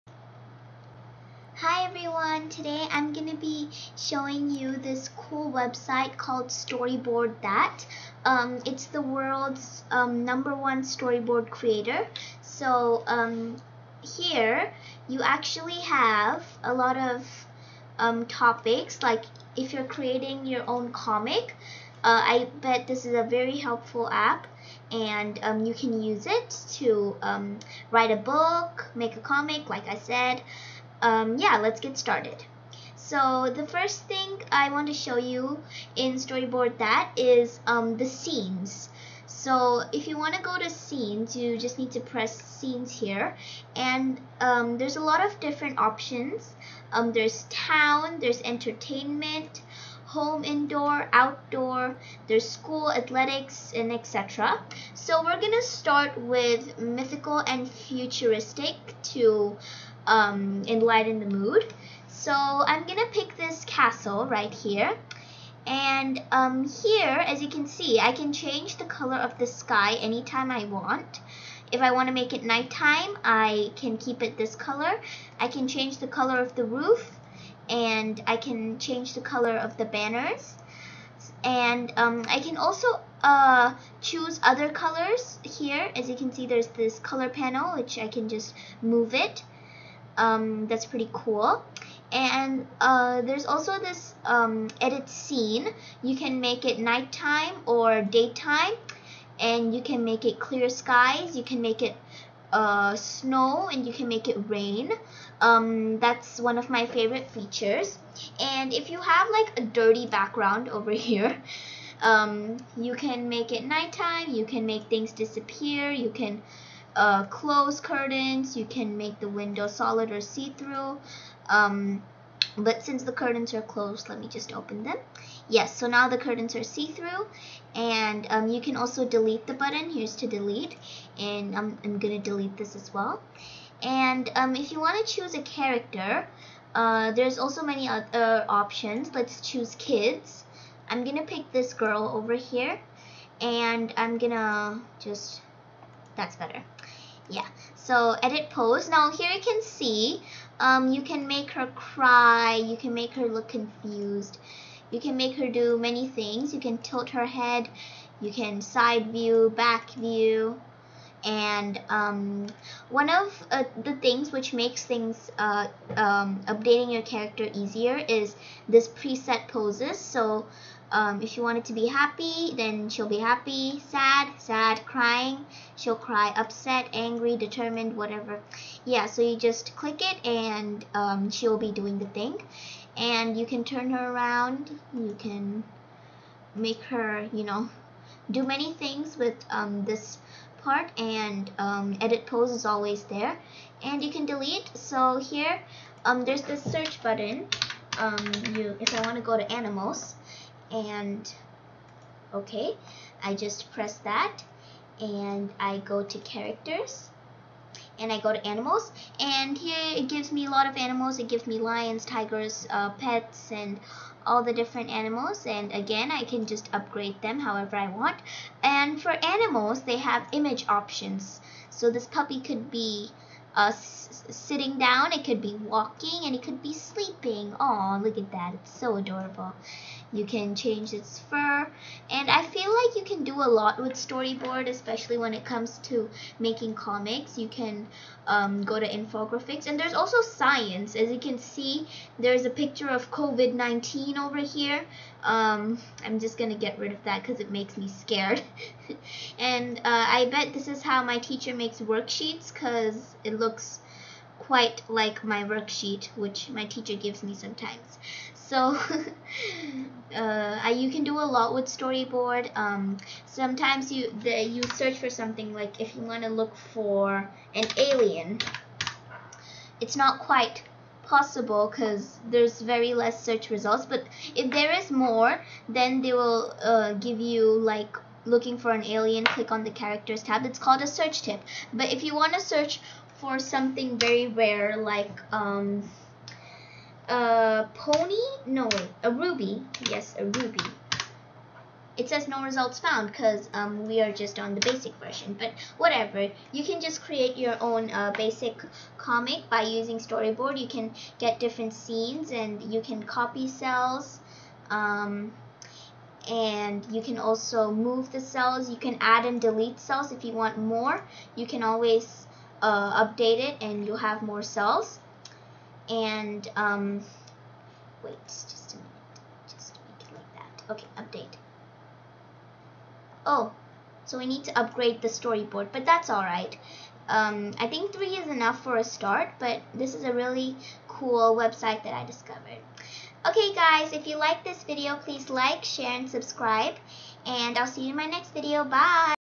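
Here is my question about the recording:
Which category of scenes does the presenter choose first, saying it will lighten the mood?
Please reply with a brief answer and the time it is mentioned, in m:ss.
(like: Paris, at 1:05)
Mythical and futuristic, at 0:56.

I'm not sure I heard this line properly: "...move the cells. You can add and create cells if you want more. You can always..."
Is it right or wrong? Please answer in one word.
wrong.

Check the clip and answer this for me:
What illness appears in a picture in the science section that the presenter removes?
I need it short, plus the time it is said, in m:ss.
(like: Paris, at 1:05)
COVID-19, at 4:03.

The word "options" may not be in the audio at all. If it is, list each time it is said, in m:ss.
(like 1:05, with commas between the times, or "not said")
0:45, 2:18, 3:40.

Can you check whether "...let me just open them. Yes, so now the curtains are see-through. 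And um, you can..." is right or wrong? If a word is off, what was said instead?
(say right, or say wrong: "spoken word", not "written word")
right.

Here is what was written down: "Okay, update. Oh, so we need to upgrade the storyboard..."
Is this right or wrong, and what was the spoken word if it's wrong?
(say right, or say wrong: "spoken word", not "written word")
right.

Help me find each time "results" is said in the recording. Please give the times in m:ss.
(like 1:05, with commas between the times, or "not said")
4:33, 4:52.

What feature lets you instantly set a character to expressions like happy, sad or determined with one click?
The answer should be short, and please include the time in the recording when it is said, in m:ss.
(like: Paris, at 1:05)
Preset poses, at 2:48.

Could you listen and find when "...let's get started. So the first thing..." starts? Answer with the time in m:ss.
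0:31.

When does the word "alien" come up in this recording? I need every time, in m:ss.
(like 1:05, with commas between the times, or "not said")
4:27, 4:38.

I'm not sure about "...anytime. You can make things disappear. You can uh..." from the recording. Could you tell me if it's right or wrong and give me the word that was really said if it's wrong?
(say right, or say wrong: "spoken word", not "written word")
wrong: "nighttime", not "anytime".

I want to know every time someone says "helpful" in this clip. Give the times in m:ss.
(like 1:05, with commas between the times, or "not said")
0:23.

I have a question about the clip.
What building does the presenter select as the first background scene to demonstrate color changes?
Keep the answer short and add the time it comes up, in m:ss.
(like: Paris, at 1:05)
Castle, at 1:03.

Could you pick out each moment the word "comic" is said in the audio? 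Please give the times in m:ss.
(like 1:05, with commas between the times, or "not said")
0:20, 0:29, 3:56, 4:58.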